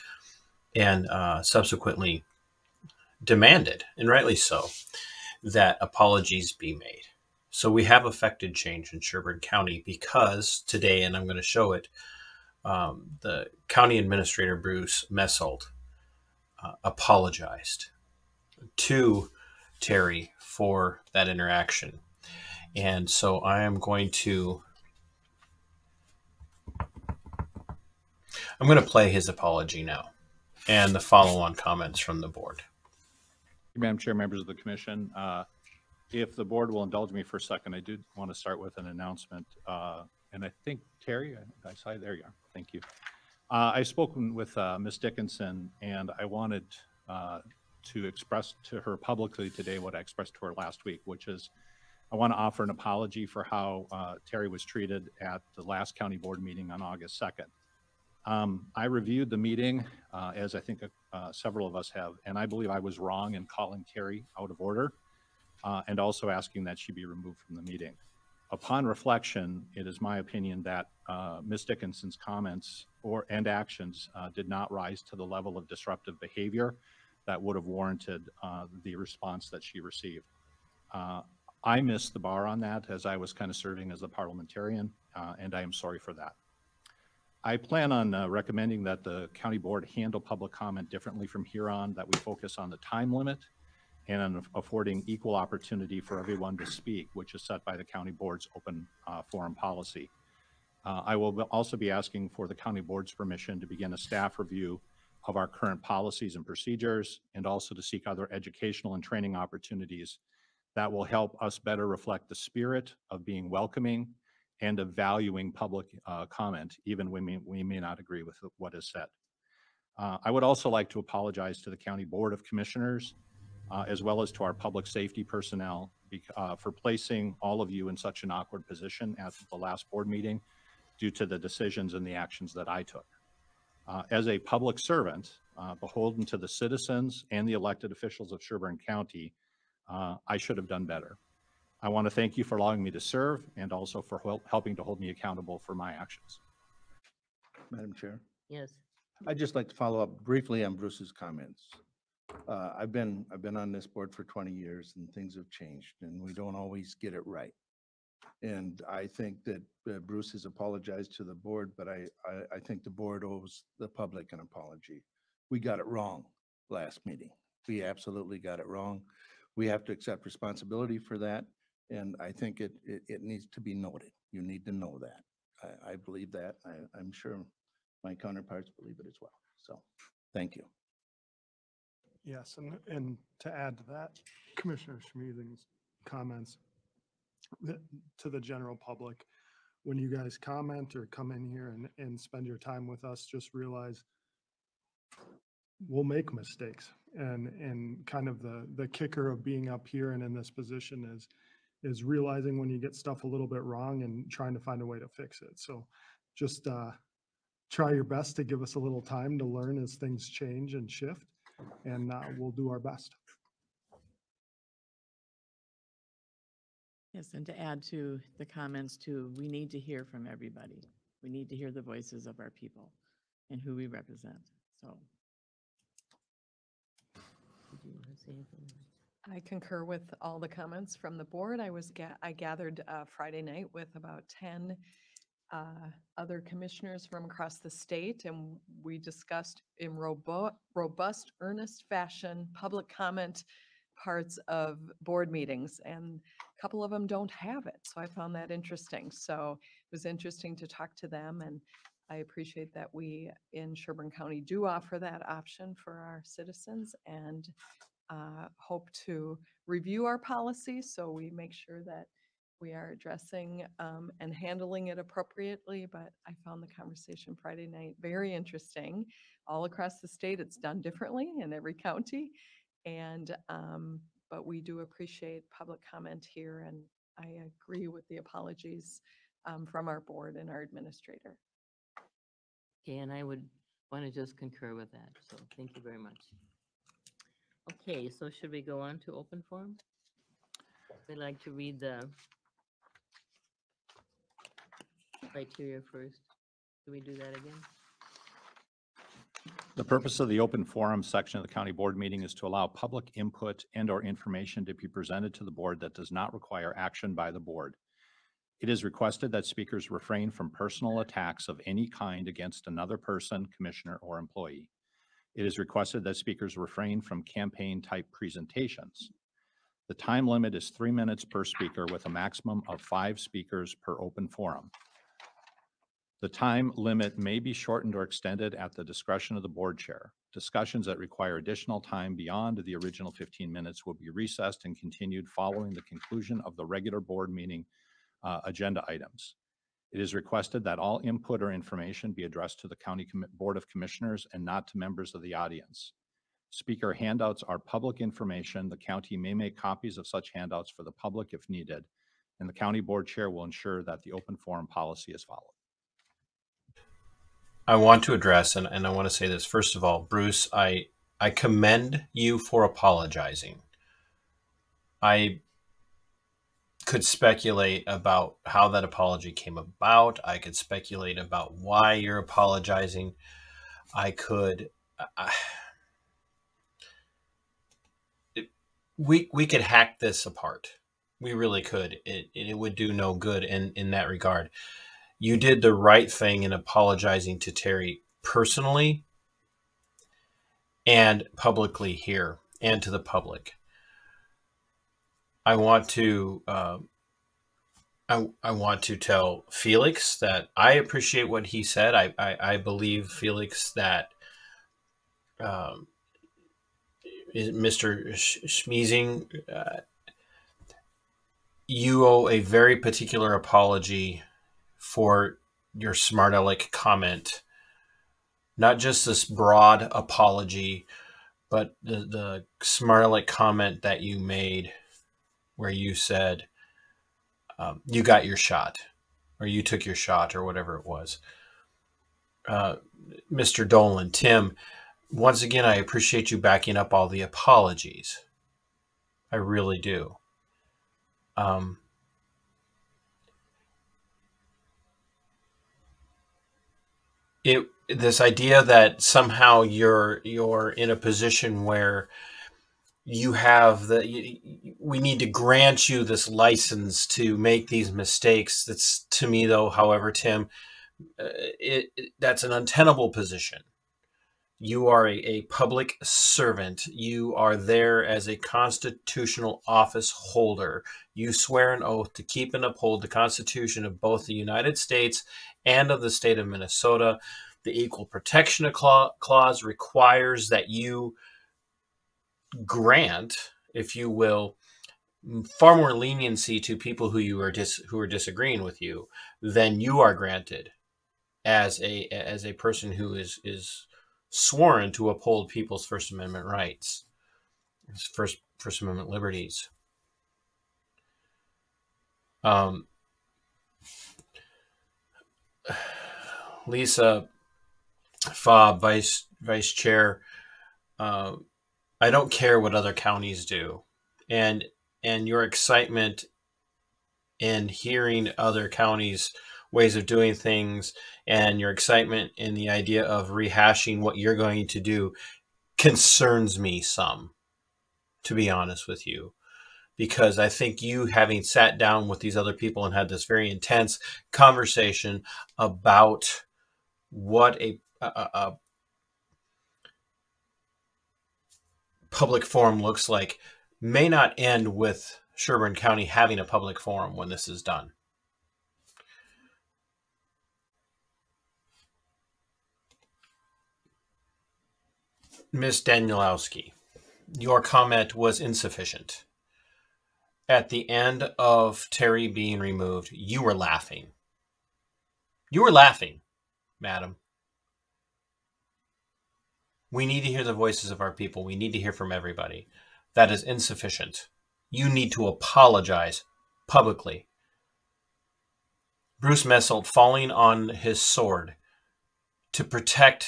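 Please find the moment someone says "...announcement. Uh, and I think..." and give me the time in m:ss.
0:38.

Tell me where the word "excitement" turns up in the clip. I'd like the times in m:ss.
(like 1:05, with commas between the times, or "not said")
8:35, 8:41.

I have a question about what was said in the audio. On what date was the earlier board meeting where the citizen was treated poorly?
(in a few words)
August 2nd.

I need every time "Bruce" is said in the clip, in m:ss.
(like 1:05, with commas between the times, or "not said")
0:14, 2:30, 2:40, 6:00, 9:39.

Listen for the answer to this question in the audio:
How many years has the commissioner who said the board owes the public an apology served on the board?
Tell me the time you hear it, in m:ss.
2:34.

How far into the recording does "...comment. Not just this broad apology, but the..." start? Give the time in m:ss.
6:56.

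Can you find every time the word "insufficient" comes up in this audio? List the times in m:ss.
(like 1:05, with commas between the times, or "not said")
9:18, 9:33.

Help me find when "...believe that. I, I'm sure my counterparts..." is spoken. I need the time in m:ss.
2:55.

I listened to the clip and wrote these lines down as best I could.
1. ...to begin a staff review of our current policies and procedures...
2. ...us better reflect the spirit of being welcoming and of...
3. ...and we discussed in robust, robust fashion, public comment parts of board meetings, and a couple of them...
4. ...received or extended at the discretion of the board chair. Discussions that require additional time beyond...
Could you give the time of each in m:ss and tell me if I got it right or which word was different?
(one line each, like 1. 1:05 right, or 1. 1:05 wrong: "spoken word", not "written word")
1. 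1:43 right
2. 1:51 right
3. 3:58 wrong: "earnest", not "robust"
4. 5:27 wrong: "shortened", not "received".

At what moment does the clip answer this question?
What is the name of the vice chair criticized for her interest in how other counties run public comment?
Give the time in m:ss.
8:26.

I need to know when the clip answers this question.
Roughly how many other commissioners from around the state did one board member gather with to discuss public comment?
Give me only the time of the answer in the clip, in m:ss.
3:54.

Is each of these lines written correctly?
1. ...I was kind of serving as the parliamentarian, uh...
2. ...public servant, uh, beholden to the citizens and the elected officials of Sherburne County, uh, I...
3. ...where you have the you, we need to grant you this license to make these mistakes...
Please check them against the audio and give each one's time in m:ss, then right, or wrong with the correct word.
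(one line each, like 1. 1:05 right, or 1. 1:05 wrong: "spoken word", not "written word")
1. 1:23 right
2. 2:14 right
3. 7:31 right.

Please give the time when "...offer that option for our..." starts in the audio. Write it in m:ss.
4:14.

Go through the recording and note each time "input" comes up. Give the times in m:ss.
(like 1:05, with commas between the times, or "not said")
5:03, 5:41.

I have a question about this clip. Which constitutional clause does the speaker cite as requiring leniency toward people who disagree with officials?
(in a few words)
Equal Protection Clause.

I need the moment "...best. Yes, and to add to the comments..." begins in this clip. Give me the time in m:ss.
3:32.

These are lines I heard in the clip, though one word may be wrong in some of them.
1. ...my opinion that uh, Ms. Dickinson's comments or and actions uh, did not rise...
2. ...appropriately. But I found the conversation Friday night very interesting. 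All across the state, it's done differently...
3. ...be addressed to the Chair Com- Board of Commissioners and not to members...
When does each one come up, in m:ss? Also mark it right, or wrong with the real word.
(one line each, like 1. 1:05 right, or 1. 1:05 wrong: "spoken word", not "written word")
1. 1:10 right
2. 4:24 right
3. 5:42 wrong: "County", not "Chair".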